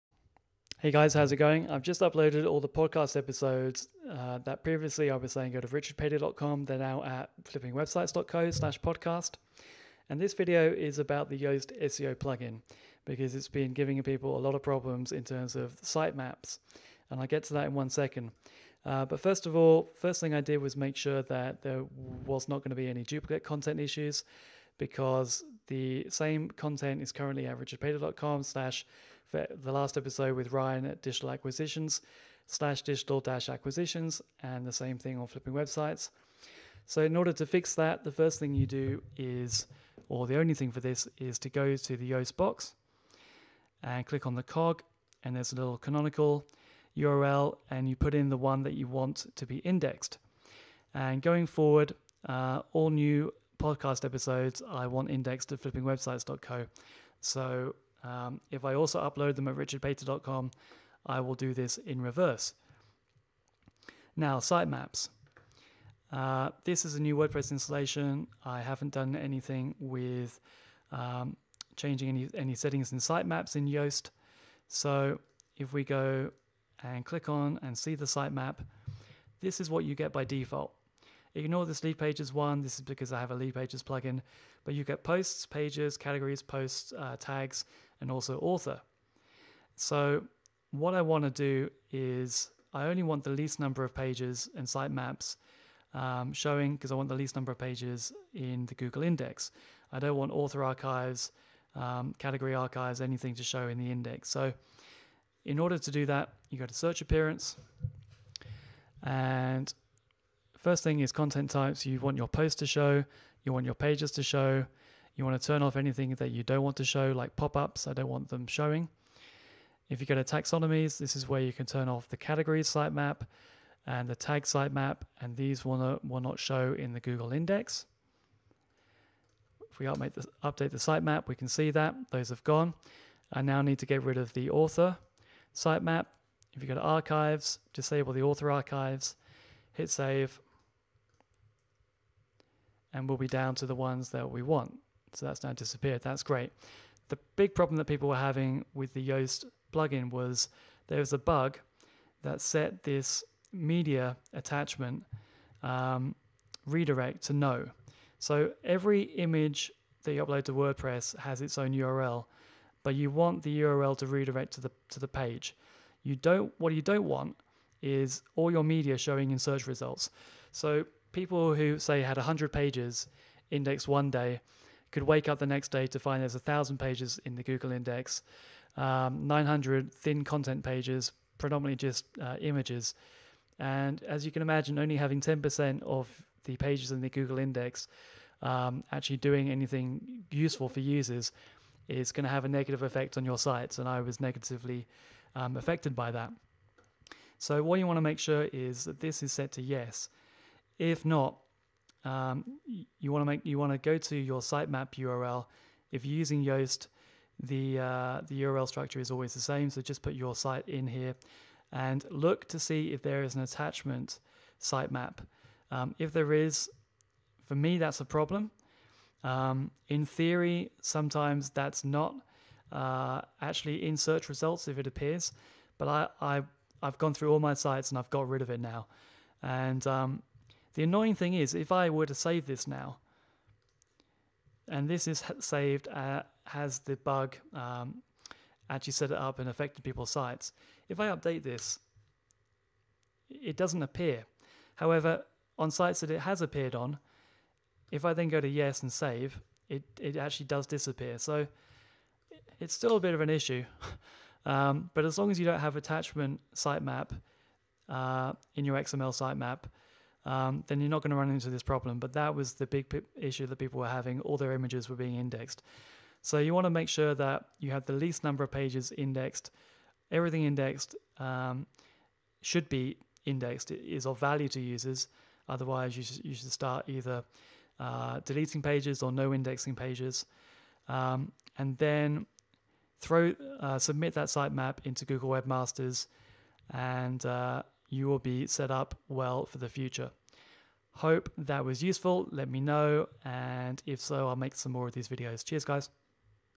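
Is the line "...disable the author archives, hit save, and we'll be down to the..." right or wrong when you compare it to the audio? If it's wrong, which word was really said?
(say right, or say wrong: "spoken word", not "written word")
right.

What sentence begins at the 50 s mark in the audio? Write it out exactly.
And going forward, uh, all new podcast episodes, I want indexed at flippingwebsites.co.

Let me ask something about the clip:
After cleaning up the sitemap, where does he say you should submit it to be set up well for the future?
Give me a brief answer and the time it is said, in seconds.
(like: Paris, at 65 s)
Google Webmasters, at 285 s.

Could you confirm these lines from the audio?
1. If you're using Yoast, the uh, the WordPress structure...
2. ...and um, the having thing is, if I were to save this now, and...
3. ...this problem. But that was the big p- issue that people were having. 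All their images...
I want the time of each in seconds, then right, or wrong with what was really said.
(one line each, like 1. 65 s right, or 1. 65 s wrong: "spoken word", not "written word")
1. 205 s wrong: "URL", not "WordPress"
2. 229 s wrong: "annoying", not "having"
3. 261 s right.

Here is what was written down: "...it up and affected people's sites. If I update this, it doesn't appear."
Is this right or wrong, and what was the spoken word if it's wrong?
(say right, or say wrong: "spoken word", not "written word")
right.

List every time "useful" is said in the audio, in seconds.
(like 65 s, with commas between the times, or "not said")
190 s, 291 s.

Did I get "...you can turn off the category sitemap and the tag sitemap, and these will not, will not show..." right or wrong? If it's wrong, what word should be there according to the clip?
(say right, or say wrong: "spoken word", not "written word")
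right.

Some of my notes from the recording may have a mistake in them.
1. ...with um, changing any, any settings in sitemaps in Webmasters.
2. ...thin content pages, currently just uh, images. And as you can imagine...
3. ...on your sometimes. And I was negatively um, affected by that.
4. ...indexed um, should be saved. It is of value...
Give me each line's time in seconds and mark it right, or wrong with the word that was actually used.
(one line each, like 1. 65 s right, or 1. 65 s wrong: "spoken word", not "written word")
1. 69 s wrong: "Yoast", not "Webmasters"
2. 179 s wrong: "predominantly", not "currently"
3. 193 s wrong: "sites", not "sometimes"
4. 270 s wrong: "indexed", not "saved".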